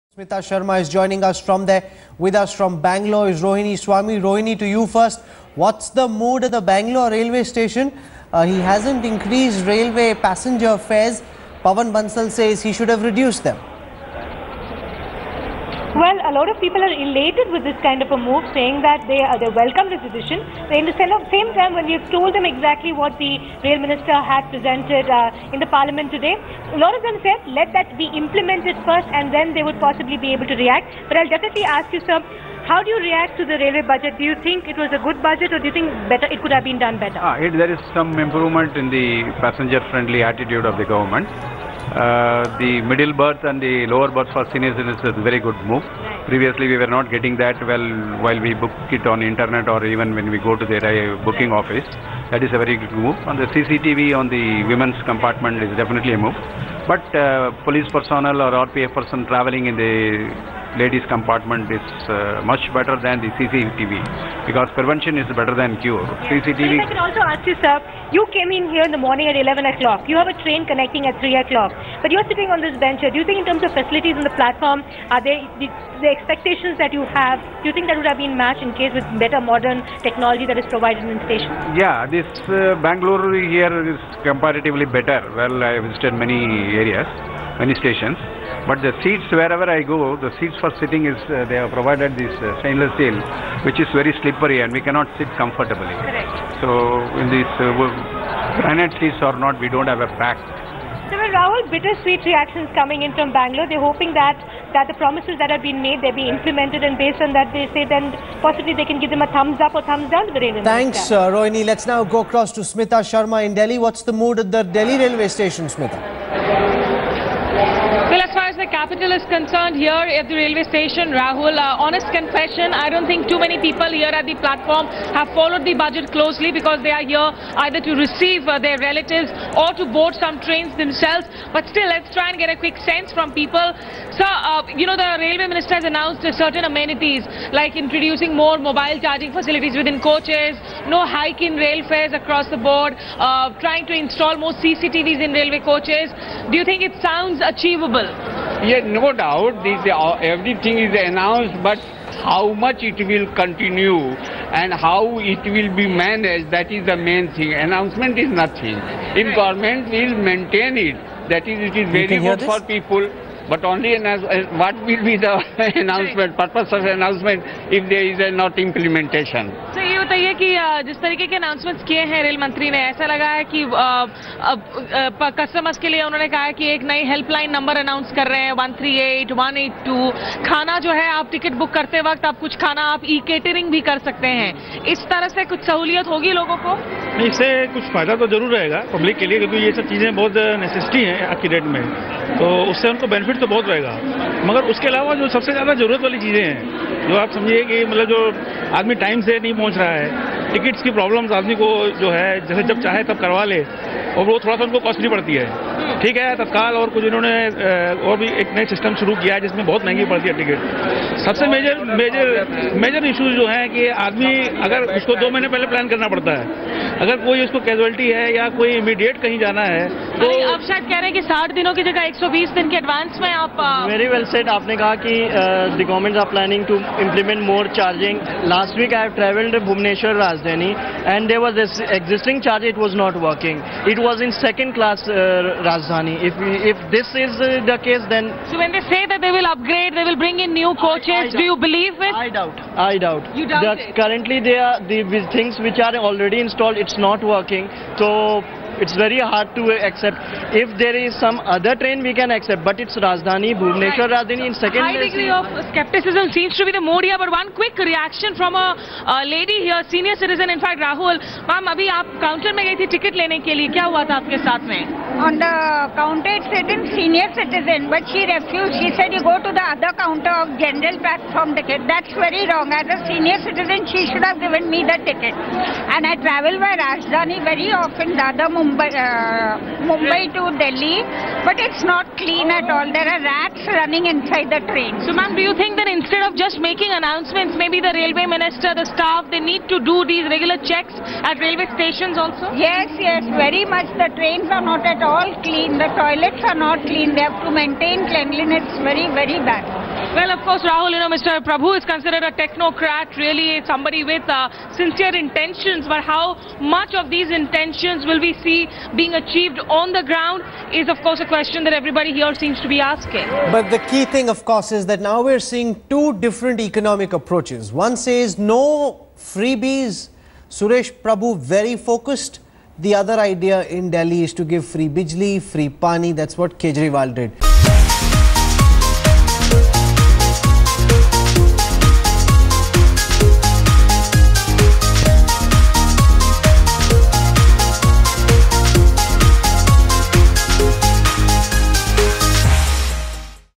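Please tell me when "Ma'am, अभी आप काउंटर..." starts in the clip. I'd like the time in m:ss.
4:21.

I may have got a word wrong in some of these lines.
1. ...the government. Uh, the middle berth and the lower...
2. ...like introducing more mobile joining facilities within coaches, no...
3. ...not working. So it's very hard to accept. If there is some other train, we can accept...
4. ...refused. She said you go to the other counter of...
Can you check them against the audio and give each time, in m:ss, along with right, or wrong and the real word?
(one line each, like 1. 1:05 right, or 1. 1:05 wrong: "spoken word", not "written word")
1. 0:40 right
2. 2:17 wrong: "charging", not "joining"
3. 4:06 right
4. 4:28 right.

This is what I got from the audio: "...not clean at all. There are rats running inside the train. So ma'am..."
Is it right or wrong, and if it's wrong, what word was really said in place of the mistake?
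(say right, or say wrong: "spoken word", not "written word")
right.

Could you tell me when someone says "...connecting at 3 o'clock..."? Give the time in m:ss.
1:10.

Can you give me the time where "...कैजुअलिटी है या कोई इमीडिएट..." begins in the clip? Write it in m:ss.
3:37.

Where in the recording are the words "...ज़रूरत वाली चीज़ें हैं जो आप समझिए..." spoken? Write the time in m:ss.
3:15.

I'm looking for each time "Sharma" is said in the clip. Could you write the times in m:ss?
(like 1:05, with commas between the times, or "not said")
0:00, 1:53.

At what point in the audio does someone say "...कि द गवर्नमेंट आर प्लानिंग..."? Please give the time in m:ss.
3:45.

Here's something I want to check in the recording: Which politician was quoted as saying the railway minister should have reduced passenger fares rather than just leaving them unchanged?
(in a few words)
Pavan Bansal.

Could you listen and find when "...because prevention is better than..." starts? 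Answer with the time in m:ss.
1:04.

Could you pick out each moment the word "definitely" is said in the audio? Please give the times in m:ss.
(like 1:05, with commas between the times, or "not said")
0:31, 0:55.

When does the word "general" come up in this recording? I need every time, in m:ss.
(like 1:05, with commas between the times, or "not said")
4:30.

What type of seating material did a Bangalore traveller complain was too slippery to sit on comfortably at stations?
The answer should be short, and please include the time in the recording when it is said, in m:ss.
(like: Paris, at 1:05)
Stainless steel, at 1:32.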